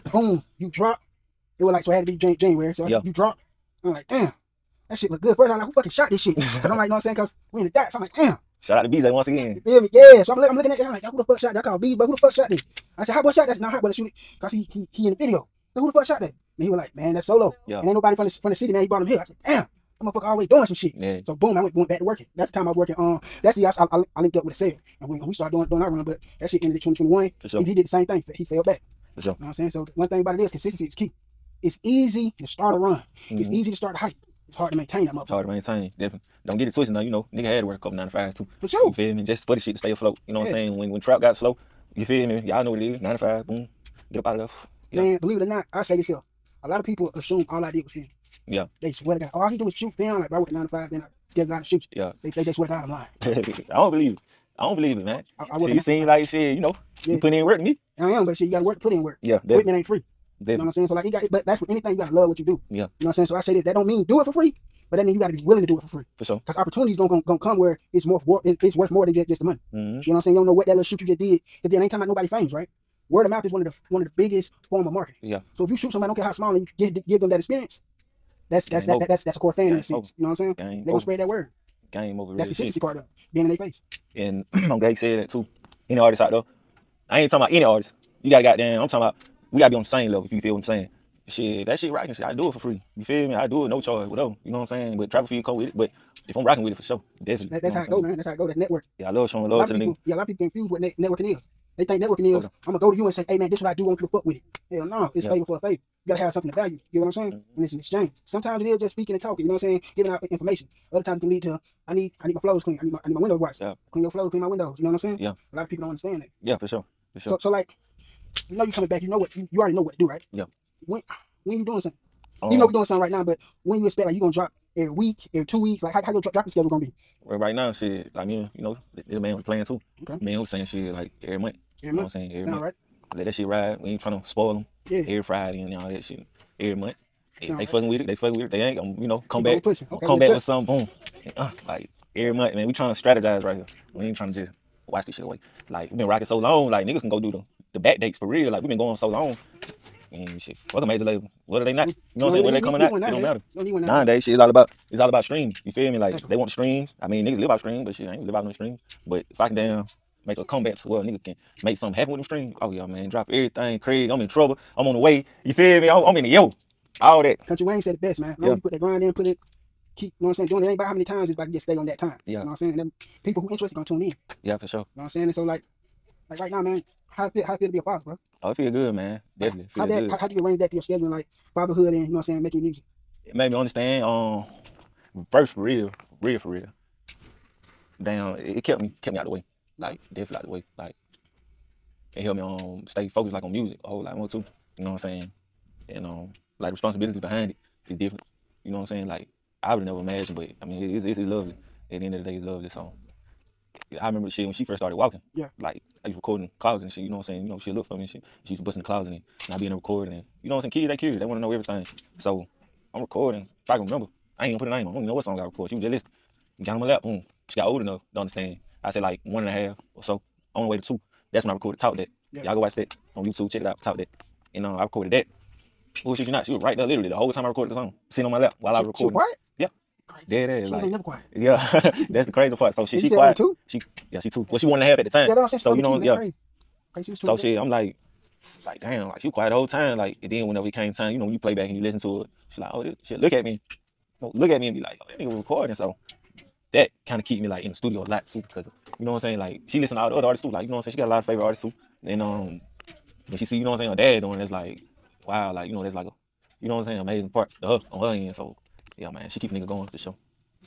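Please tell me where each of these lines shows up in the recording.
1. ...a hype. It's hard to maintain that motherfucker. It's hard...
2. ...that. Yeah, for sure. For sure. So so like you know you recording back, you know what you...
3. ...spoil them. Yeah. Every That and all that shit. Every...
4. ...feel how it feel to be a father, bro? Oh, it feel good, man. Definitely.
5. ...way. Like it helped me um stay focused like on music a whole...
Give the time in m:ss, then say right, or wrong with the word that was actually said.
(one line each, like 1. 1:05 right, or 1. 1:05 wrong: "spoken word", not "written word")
1. 0:33 right
2. 1:56 wrong: "coming", not "recording"
3. 2:14 wrong: "Friday", not "That"
4. 2:57 right
5. 3:10 right.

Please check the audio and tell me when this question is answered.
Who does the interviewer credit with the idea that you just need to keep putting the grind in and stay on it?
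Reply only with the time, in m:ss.
2:47.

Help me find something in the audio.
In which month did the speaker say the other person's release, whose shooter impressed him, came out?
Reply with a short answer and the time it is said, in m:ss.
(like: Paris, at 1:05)
January, at 0:02.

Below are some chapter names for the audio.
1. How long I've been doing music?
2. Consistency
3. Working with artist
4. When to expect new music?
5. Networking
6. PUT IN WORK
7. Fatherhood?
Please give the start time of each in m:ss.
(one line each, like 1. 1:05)
1. 2:24
2. 0:29
3. 1:23
4. 1:59
5. 1:40
6. 0:57
7. 2:55.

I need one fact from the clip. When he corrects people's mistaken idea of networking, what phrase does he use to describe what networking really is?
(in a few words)
favor for a favor.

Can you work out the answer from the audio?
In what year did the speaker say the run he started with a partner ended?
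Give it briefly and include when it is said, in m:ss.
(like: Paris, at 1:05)
2021, at 0:26.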